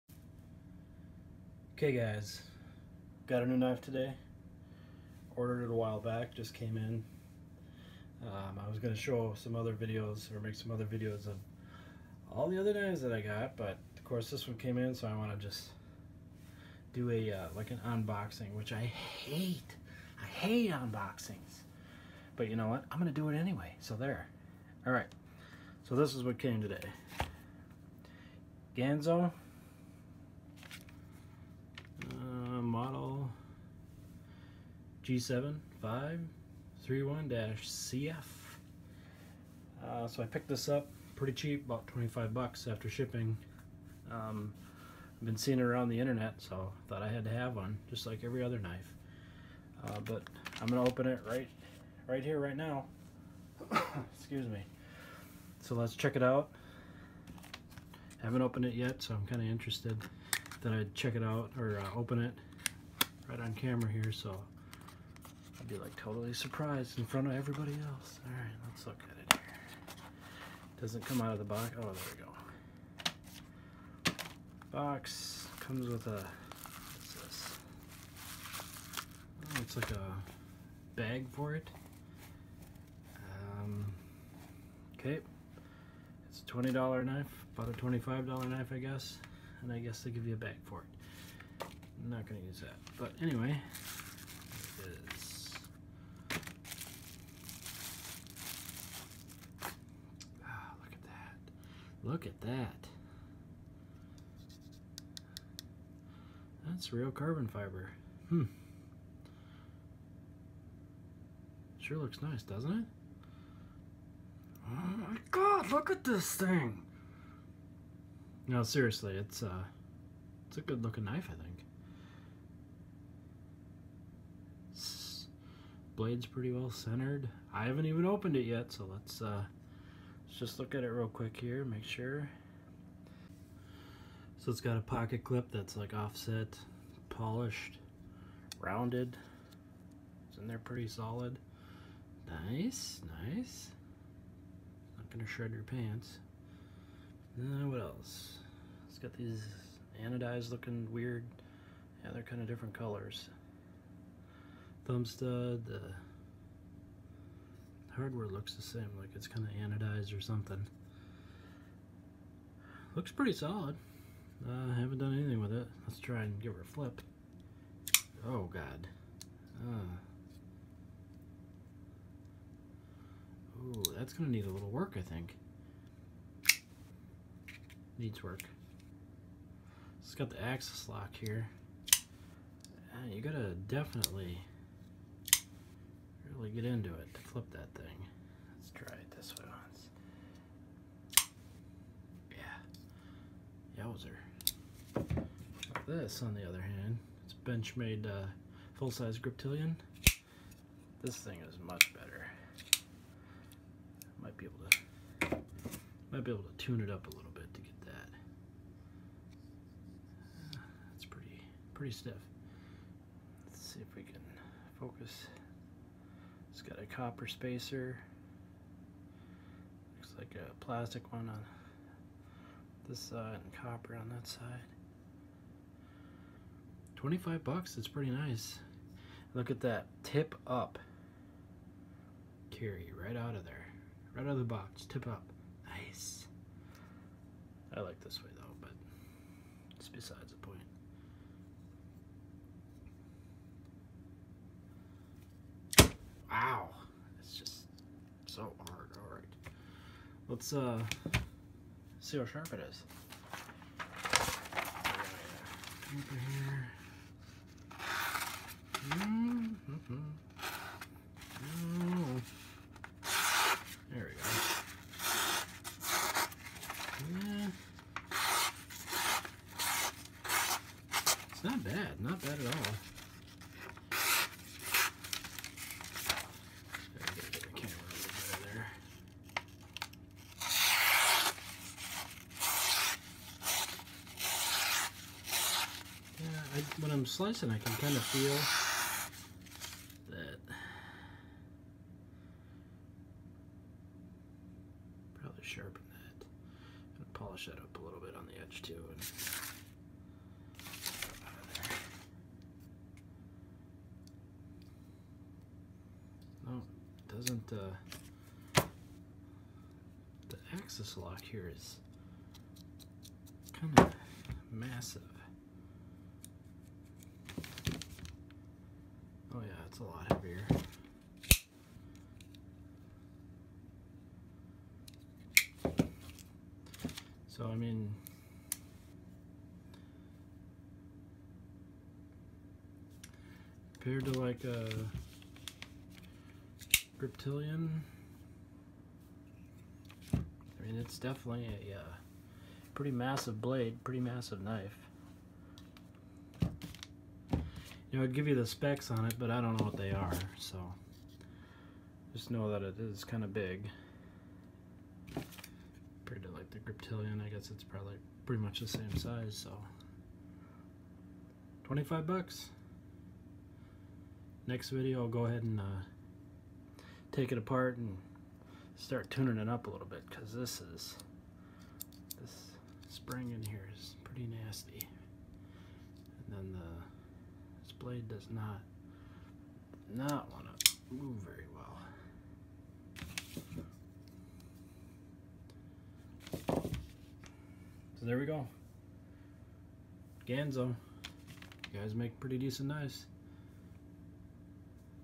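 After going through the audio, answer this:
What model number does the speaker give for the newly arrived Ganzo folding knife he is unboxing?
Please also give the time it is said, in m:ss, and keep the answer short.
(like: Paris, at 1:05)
G7531-CF, at 0:35.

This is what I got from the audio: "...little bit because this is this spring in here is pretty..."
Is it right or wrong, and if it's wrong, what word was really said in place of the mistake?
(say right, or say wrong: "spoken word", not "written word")
right.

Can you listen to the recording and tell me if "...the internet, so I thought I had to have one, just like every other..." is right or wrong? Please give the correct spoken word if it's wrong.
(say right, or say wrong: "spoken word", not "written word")
right.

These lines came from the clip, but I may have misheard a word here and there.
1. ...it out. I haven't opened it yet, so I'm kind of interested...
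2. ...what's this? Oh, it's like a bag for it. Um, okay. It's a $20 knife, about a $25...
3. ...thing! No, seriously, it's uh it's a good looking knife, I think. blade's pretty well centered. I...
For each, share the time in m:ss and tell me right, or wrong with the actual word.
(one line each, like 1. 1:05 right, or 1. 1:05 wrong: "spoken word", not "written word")
1. 0:56 right
2. 1:16 right
3. 1:56 right.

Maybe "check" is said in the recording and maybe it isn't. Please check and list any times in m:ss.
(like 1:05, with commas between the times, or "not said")
0:55, 1:00.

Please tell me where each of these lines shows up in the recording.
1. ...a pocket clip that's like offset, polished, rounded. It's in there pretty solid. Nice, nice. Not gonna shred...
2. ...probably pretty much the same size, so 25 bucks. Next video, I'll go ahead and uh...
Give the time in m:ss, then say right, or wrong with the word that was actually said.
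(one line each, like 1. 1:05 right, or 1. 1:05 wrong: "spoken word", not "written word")
1. 2:14 right
2. 5:57 right.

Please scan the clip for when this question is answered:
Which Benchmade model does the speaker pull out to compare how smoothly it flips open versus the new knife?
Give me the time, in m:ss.
3:18.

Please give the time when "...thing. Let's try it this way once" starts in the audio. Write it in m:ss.
3:07.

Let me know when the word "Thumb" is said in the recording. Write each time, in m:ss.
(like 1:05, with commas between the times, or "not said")
2:34.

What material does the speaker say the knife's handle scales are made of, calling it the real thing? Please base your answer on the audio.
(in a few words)
carbon fiber.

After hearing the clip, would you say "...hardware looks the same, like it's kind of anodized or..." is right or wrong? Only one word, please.
right.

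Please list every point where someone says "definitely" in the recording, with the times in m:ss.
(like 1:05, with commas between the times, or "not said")
3:03, 5:40.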